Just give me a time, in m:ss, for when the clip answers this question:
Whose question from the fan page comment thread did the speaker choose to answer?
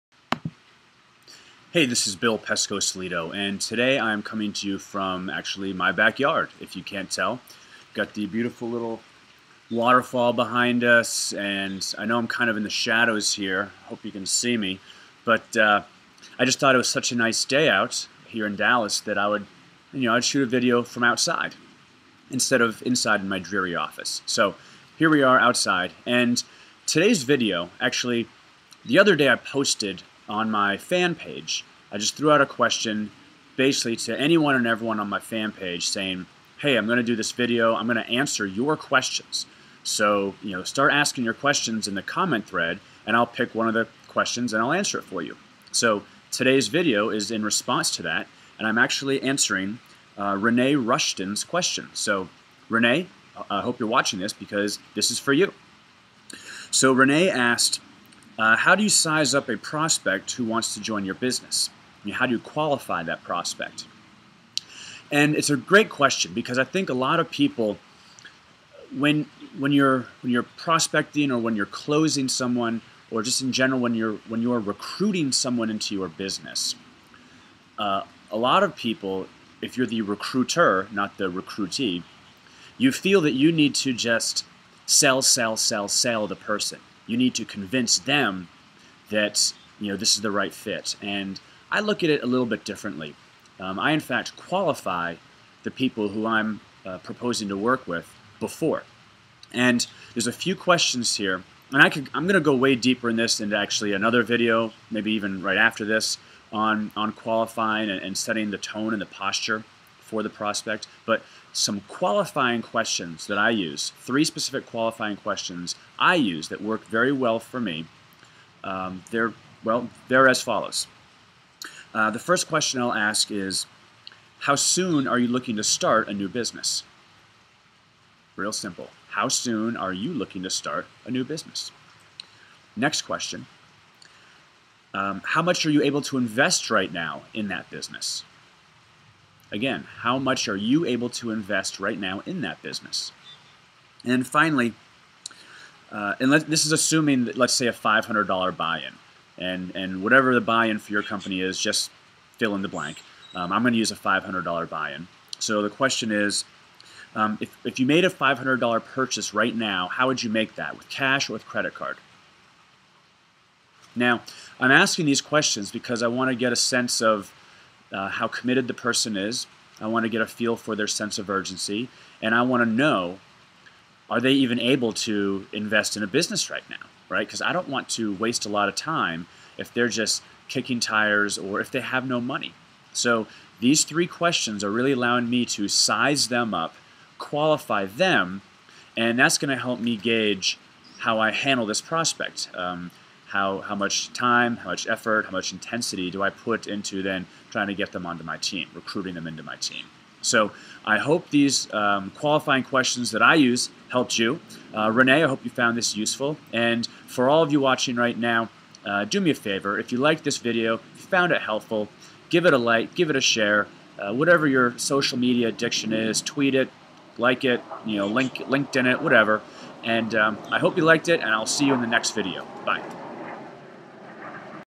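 0:50.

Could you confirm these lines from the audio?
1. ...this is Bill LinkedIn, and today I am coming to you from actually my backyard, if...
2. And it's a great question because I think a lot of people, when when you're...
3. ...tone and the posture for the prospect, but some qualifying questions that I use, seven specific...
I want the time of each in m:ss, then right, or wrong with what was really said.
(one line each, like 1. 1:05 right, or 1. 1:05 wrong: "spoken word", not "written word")
1. 0:01 wrong: "Pescosolido", not "LinkedIn"
2. 1:05 right
3. 1:48 wrong: "three", not "seven".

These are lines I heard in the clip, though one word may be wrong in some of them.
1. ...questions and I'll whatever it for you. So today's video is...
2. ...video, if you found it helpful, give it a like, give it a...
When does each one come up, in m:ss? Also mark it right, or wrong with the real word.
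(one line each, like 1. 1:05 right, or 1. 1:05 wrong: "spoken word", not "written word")
1. 0:44 wrong: "answer", not "whatever"
2. 3:30 right.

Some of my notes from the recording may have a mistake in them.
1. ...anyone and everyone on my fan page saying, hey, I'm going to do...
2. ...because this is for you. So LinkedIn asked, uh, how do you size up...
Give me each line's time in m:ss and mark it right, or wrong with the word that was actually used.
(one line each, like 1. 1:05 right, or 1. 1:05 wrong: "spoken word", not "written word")
1. 0:34 right
2. 0:54 wrong: "Renee", not "LinkedIn".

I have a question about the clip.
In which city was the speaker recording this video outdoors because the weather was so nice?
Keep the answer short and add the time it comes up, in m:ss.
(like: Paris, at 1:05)
Dallas, at 0:18.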